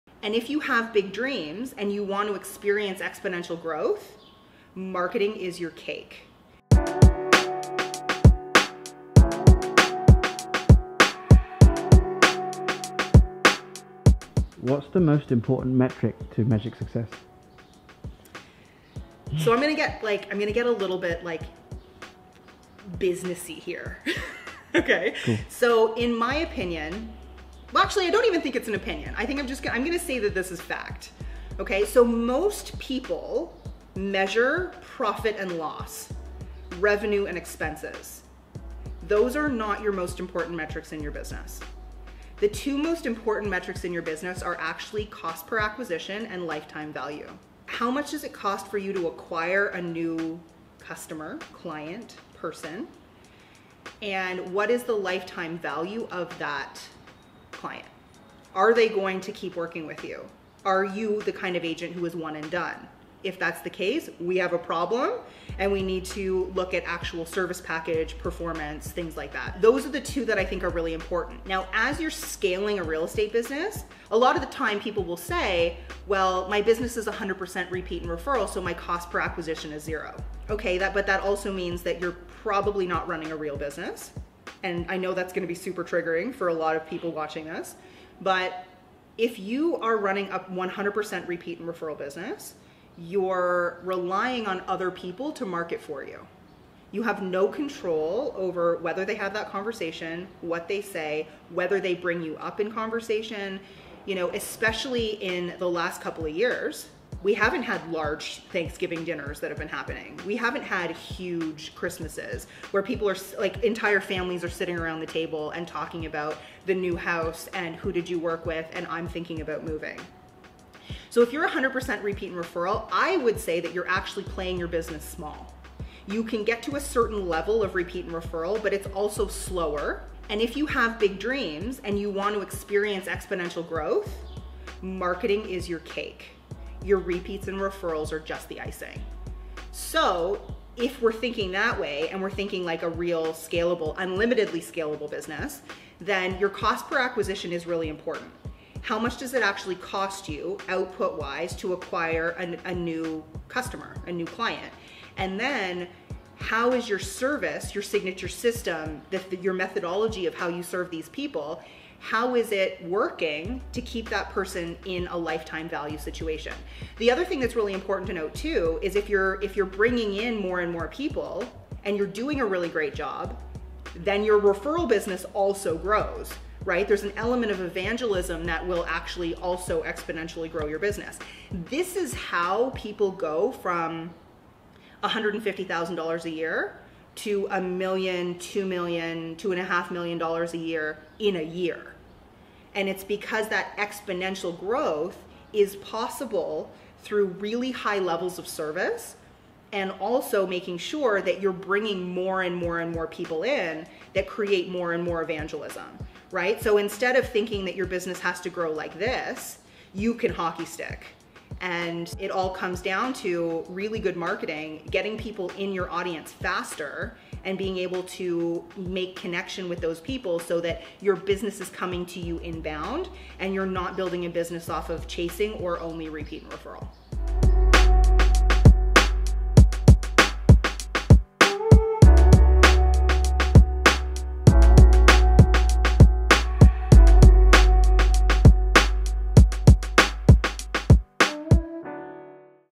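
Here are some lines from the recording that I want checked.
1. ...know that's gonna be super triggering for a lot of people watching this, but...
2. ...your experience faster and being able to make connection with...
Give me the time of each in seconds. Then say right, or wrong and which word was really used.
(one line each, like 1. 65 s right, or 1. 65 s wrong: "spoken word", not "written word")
1. 84 s right
2. 215 s wrong: "audience", not "experience".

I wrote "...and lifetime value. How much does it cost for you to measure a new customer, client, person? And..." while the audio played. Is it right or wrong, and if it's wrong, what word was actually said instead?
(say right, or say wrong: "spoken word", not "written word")
wrong: "acquire", not "measure".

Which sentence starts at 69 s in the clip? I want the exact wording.
Those are the two that I think are really important.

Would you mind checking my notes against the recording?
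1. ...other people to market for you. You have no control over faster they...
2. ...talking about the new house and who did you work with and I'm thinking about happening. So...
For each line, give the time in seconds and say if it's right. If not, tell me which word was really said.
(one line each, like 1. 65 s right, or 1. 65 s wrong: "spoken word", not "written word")
1. 94 s wrong: "whether", not "faster"
2. 115 s wrong: "moving", not "happening".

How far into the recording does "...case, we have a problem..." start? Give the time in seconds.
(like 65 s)
63 s.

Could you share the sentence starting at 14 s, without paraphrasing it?
What's the most important metric to magic success?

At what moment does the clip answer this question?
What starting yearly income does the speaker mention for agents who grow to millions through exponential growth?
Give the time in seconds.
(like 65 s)
185 s.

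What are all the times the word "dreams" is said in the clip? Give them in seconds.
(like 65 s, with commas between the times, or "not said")
1 s, 131 s.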